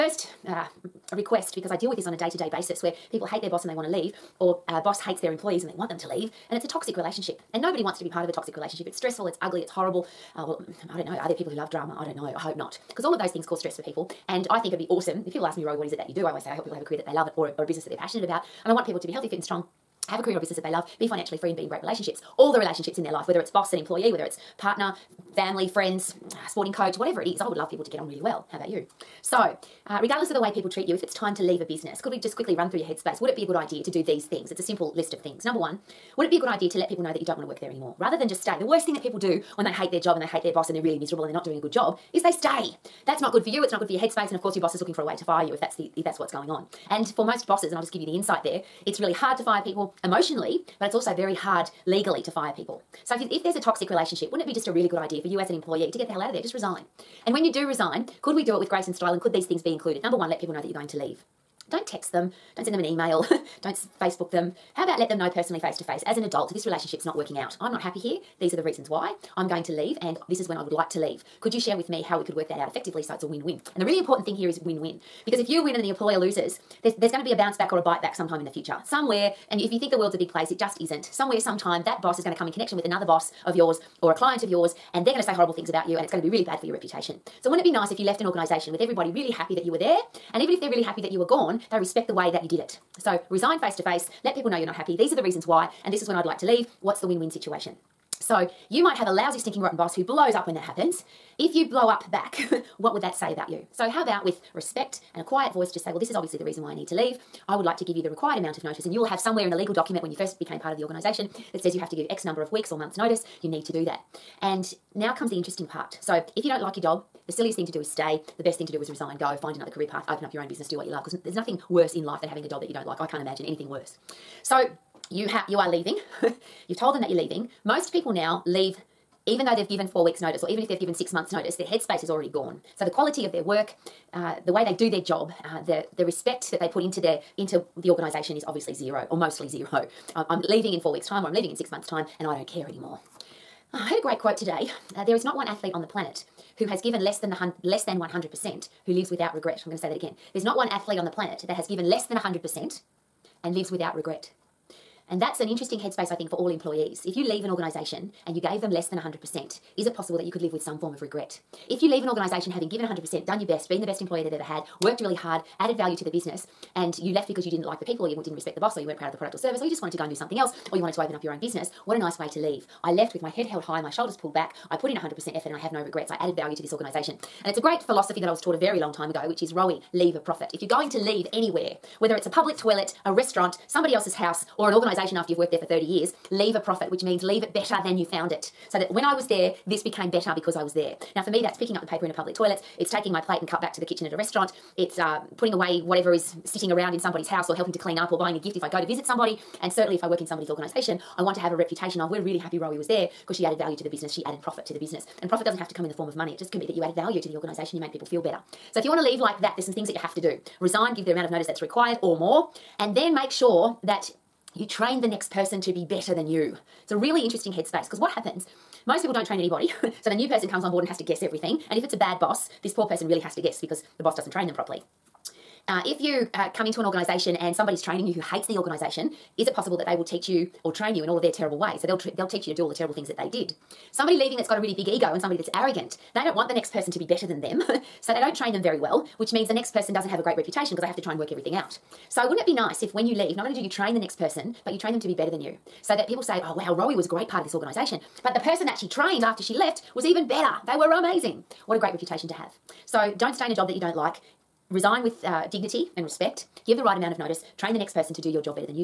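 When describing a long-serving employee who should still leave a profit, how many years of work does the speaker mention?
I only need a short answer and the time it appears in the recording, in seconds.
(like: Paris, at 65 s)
30, at 185 s.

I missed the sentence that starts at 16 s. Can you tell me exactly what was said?
I always say I help people have a career that they love or a, or a business that they're passionate about.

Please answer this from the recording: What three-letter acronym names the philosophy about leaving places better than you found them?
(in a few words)
ROE.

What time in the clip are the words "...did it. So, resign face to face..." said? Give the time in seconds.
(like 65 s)
92 s.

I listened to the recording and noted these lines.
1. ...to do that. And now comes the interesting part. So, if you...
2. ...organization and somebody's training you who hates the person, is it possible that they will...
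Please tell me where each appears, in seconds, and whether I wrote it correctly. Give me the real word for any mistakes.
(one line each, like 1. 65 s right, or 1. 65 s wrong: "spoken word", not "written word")
1. 113 s right
2. 226 s wrong: "organization", not "person".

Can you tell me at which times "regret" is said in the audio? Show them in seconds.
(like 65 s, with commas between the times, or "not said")
149 s, 153 s, 161 s, 175 s.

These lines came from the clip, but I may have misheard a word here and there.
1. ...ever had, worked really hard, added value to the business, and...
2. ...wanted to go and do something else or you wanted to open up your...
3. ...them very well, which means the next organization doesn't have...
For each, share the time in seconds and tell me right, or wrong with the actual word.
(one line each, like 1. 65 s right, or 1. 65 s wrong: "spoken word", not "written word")
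1. 164 s right
2. 169 s right
3. 238 s wrong: "person", not "organization".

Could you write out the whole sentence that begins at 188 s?
So that when I was there, this became better because I was there.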